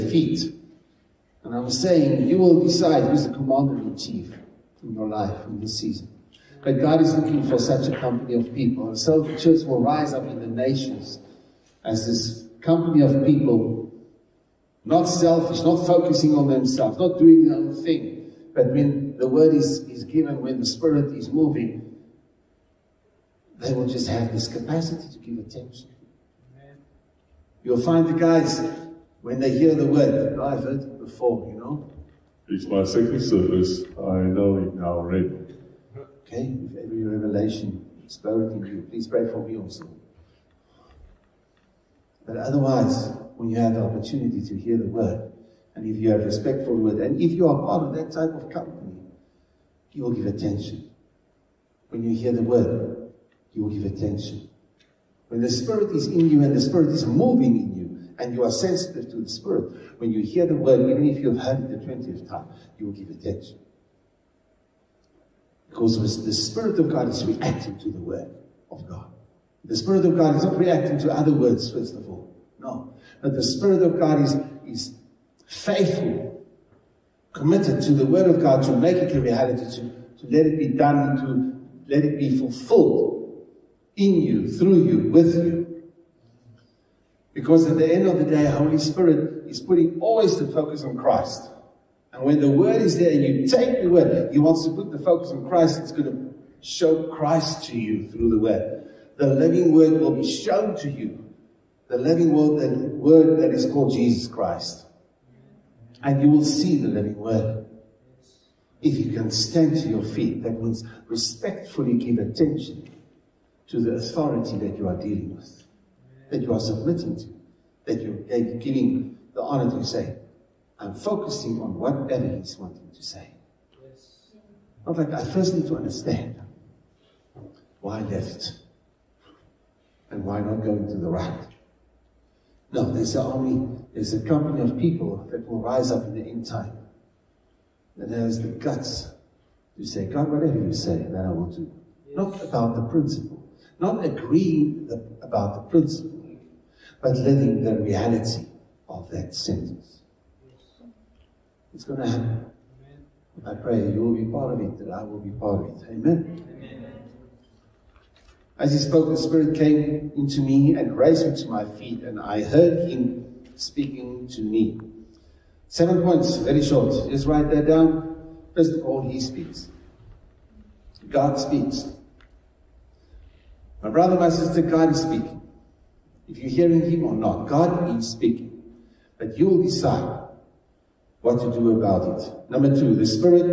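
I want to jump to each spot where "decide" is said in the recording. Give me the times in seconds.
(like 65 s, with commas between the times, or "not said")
2 s, 179 s.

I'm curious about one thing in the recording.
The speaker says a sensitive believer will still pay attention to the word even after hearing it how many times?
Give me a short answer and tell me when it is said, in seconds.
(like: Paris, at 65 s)
20th time, at 61 s.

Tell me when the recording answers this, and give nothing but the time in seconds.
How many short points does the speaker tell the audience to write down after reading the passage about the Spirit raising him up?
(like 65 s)
165 s.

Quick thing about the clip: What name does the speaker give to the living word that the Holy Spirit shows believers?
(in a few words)
Jesus Christ.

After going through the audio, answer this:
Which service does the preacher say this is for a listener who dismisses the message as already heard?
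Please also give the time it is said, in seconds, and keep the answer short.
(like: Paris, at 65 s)
second service, at 32 s.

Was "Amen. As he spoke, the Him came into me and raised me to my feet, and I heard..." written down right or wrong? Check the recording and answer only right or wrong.
wrong.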